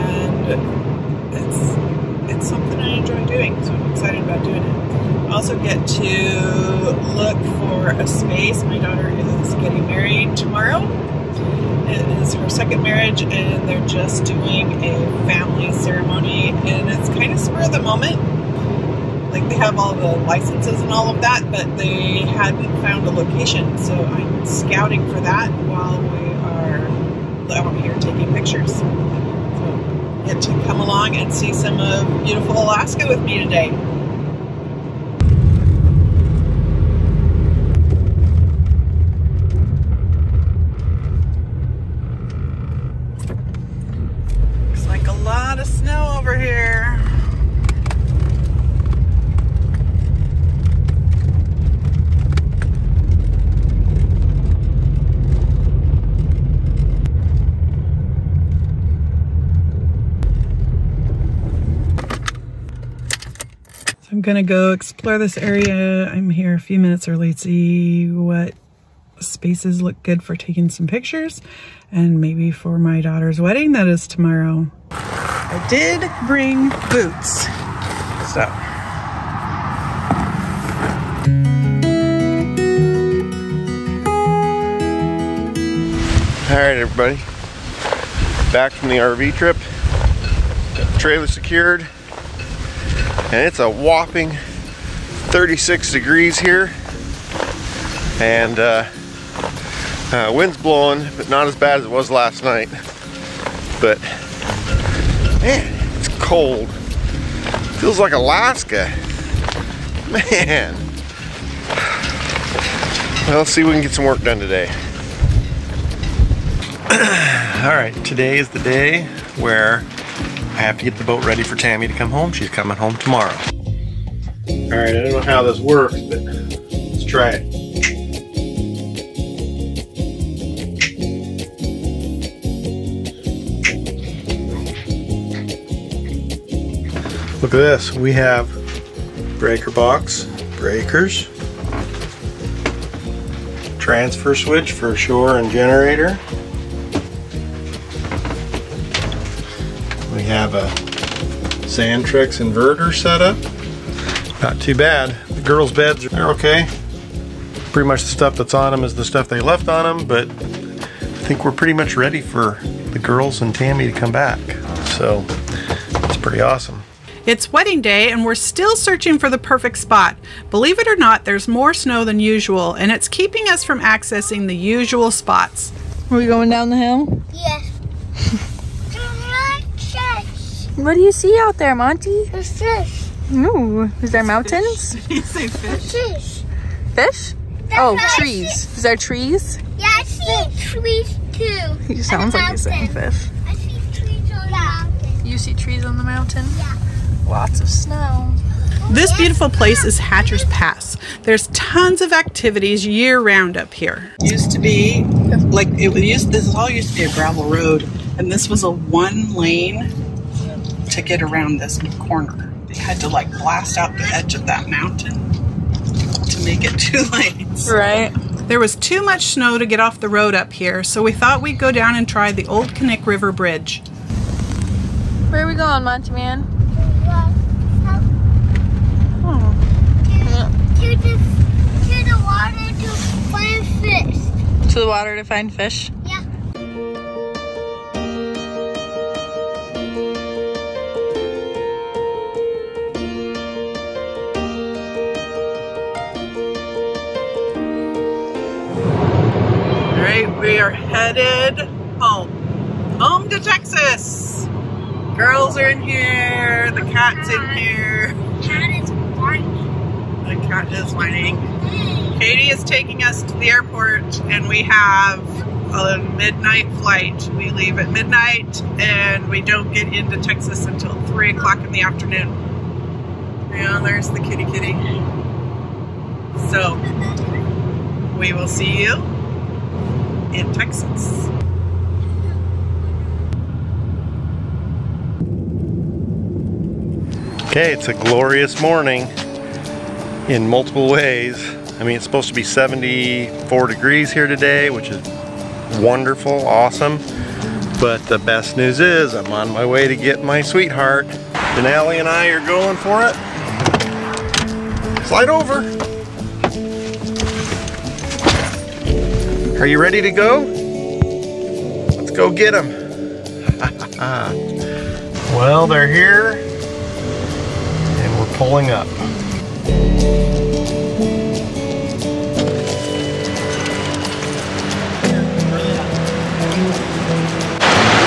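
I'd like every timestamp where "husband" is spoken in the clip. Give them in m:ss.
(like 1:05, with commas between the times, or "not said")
not said.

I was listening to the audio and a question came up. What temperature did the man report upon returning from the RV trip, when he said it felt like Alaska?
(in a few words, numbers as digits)
36 degrees.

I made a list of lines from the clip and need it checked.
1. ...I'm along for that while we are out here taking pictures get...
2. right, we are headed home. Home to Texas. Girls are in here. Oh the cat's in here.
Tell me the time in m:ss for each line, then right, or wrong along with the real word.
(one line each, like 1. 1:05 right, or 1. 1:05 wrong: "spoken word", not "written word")
1. 0:23 wrong: "scouting", not "along"
2. 4:10 right.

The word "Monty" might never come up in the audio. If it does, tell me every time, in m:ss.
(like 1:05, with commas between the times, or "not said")
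3:01, 3:45.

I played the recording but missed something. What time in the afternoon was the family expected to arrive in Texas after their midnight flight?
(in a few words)
3 o'clock.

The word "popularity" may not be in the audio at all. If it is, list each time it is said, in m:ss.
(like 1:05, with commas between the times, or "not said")
not said.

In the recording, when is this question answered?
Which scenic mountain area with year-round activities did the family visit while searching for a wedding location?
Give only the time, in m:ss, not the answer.
3:19.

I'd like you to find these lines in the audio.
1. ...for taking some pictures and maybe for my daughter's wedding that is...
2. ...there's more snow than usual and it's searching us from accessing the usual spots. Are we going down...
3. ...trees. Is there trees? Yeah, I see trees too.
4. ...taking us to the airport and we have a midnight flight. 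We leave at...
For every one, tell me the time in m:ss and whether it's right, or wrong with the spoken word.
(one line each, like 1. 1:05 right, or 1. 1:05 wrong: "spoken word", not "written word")
1. 1:10 right
2. 2:51 wrong: "keeping", not "searching"
3. 3:08 right
4. 4:22 right.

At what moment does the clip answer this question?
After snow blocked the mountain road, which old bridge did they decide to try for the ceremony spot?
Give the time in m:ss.
3:42.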